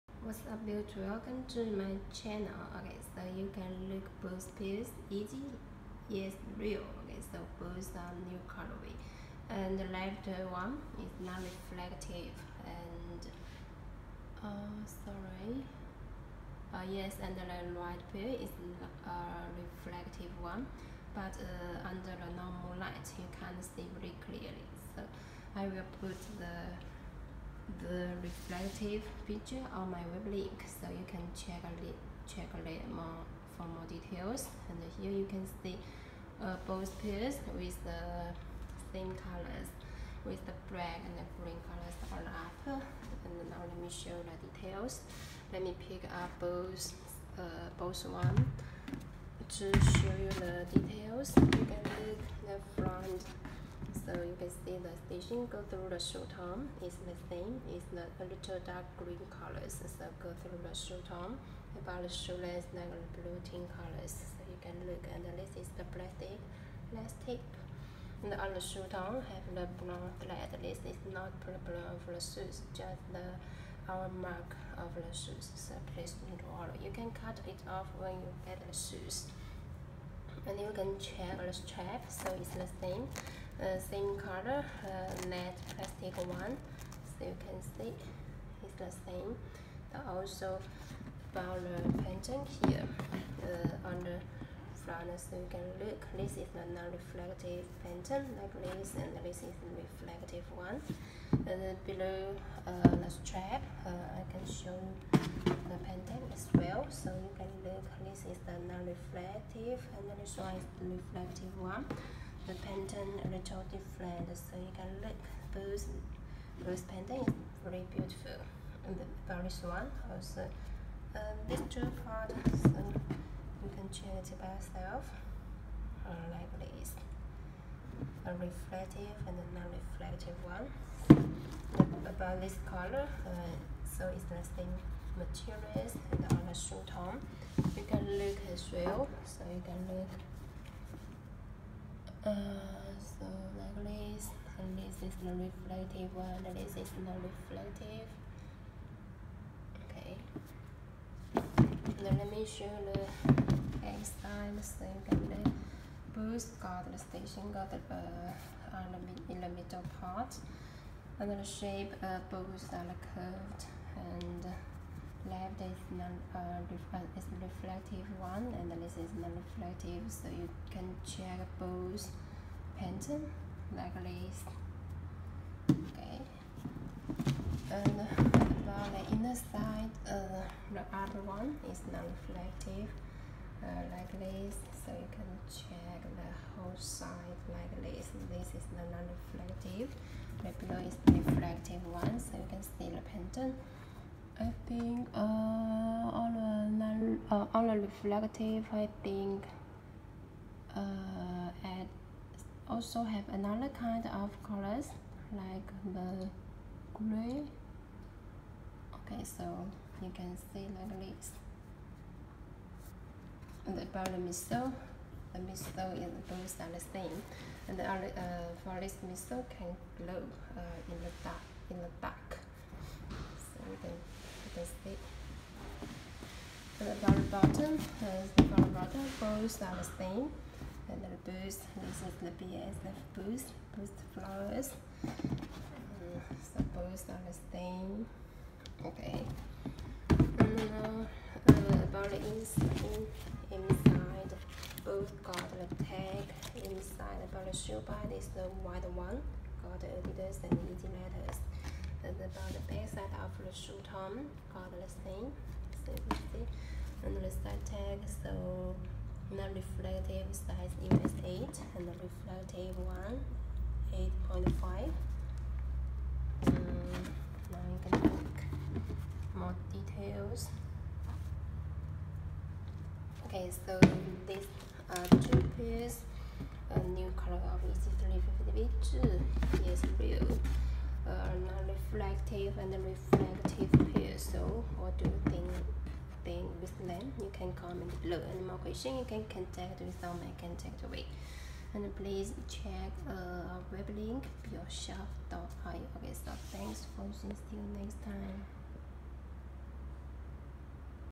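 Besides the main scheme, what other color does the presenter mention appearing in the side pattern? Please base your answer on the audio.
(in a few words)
Gray.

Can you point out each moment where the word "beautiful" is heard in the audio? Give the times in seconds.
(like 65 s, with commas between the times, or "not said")
117 s.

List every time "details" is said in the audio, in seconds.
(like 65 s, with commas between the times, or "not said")
33 s, 44 s, 50 s, 269 s.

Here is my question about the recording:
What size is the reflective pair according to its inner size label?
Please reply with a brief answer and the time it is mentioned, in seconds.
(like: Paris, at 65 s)
8.5, at 264 s.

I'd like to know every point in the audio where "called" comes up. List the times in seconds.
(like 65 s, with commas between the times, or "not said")
254 s.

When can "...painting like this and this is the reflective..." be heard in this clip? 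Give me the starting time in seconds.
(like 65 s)
97 s.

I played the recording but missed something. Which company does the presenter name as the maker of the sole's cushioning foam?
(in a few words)
BASF.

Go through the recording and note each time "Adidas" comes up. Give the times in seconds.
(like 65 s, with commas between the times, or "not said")
250 s.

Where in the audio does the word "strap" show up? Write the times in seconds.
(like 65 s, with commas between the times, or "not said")
81 s, 103 s.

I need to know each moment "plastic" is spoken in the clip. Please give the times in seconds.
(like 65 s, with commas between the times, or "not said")
65 s, 85 s.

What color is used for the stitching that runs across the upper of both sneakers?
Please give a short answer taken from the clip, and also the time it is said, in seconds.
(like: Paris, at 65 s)
Dark green, at 58 s.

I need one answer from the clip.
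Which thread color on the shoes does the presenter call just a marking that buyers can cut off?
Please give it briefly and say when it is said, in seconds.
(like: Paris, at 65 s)
Brown, at 69 s.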